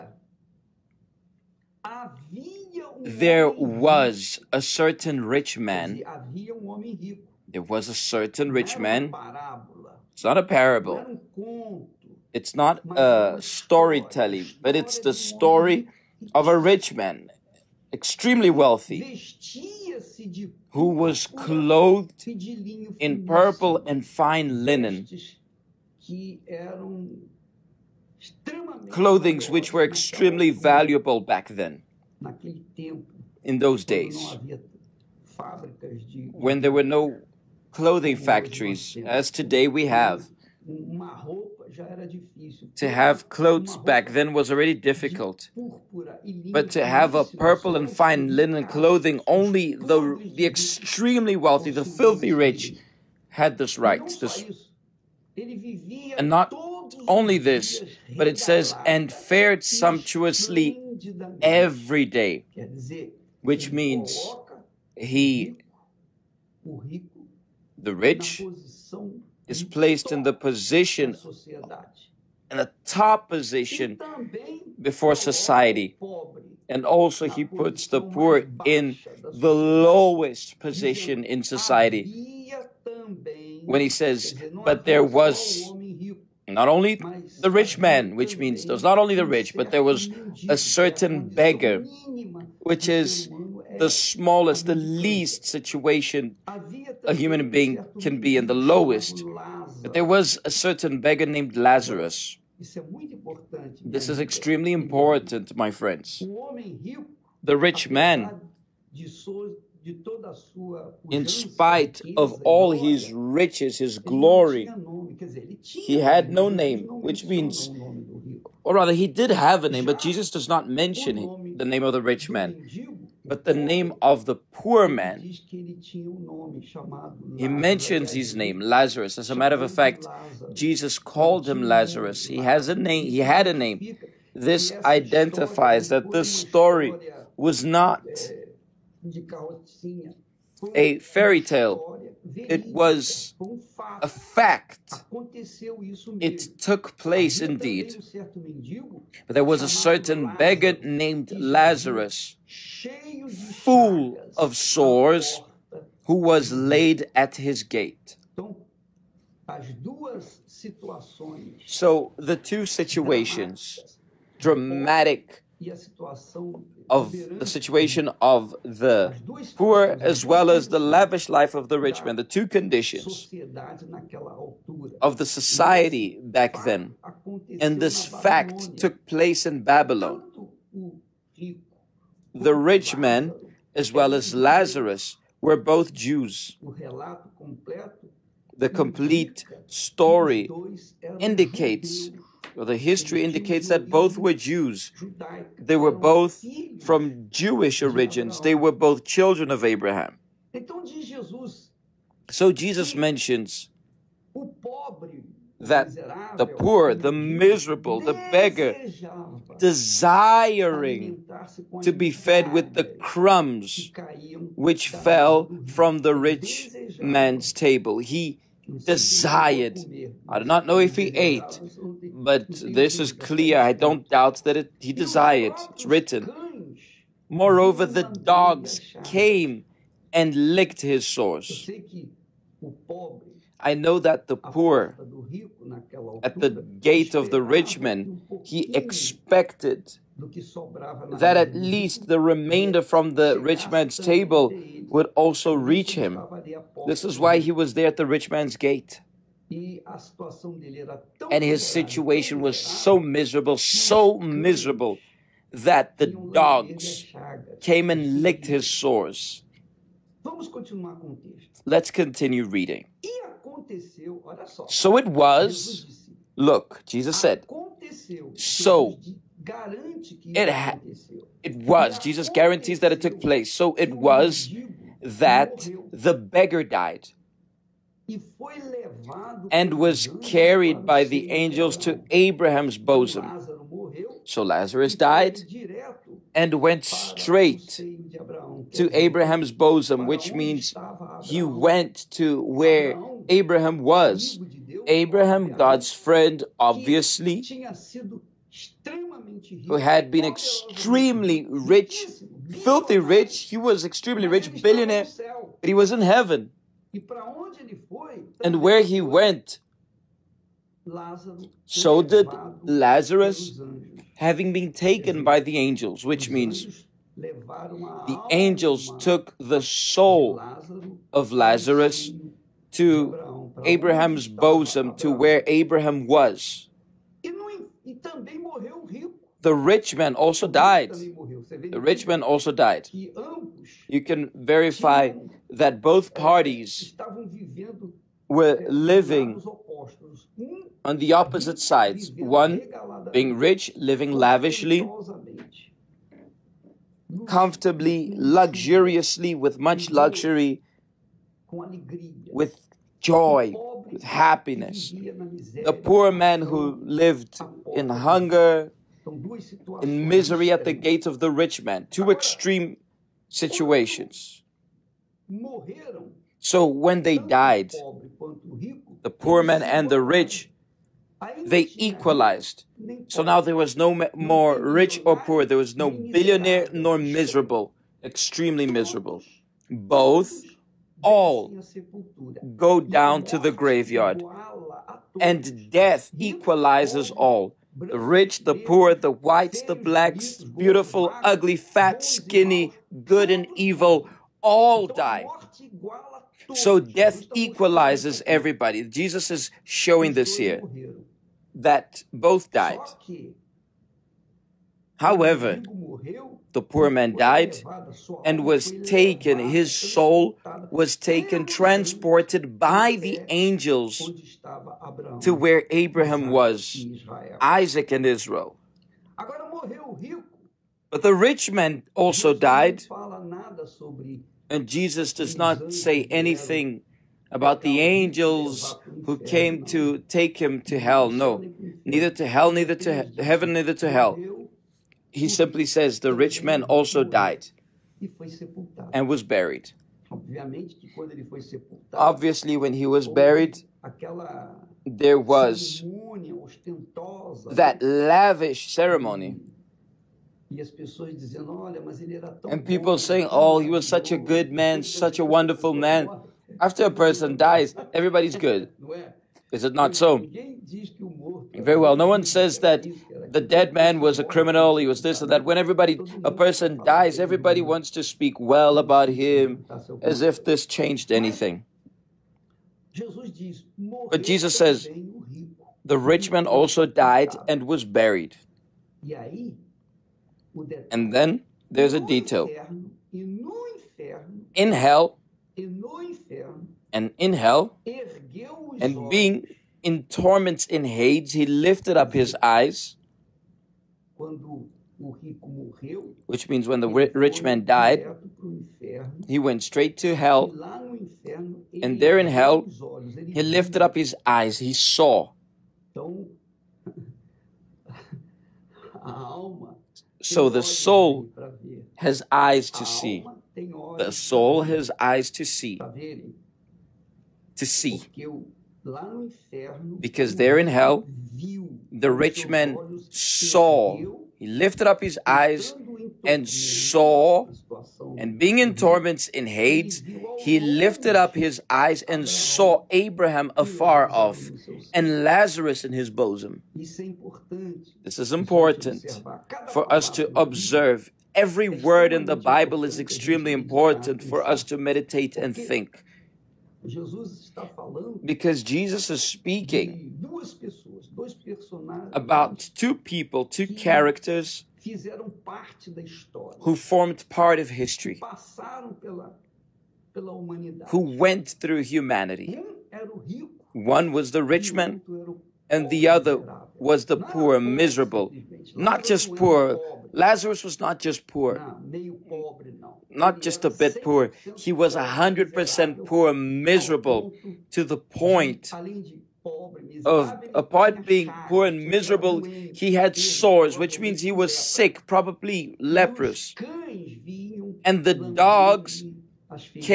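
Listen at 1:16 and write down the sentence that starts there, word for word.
And also, he puts the poor in the lowest position in society.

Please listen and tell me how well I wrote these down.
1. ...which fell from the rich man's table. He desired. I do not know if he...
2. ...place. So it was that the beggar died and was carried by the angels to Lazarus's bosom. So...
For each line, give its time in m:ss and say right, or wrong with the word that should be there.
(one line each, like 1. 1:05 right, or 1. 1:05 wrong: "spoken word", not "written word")
1. 3:34 right
2. 4:33 wrong: "Abraham", not "Lazarus".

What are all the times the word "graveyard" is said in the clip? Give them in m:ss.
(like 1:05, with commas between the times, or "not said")
6:23.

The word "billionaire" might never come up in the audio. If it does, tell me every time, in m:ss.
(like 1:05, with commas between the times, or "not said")
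5:04, 6:15.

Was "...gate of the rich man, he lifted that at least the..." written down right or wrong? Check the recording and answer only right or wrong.
wrong.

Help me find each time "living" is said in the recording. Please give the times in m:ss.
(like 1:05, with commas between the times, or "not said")
5:38, 5:43.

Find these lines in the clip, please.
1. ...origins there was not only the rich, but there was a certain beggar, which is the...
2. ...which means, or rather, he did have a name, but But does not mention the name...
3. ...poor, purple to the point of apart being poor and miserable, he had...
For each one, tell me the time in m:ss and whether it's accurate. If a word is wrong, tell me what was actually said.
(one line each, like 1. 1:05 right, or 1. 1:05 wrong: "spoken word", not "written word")
1. 1:28 wrong: "means", not "origins"
2. 1:57 wrong: "Jesus", not "But"
3. 9:36 wrong: "miserable", not "purple".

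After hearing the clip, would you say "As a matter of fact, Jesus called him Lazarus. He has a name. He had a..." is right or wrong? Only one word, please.
right.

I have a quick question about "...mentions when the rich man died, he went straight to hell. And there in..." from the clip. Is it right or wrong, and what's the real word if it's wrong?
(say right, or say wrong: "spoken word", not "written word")
wrong: "means", not "mentions".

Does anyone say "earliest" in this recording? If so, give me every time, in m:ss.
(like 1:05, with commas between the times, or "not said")
not said.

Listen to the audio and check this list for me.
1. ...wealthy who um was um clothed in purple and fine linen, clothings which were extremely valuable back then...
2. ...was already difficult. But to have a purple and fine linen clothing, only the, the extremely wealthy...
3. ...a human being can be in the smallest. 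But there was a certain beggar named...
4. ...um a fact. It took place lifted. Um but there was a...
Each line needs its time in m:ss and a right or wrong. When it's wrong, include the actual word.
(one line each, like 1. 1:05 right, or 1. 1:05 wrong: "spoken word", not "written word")
1. 0:18 right
2. 0:44 right
3. 1:37 wrong: "lowest", not "smallest"
4. 2:23 wrong: "indeed", not "lifted".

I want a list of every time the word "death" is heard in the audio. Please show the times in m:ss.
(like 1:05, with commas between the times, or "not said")
6:25, 6:36.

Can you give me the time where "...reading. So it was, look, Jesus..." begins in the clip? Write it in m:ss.
4:22.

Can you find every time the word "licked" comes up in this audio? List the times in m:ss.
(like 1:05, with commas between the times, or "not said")
3:50, 4:18.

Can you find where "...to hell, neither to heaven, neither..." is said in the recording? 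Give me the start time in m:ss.
7:12.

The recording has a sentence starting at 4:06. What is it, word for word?
This is why he was there at the rich man's gate.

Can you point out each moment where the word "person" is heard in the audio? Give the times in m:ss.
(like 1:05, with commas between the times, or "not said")
7:36, 7:46.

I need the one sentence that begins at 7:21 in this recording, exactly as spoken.
Obviously, when he was buried, there was that lavish ceremony.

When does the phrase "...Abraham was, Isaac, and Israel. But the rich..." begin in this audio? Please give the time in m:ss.
6:55.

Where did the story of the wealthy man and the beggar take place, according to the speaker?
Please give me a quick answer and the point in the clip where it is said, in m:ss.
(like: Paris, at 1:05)
Babylon, at 2:59.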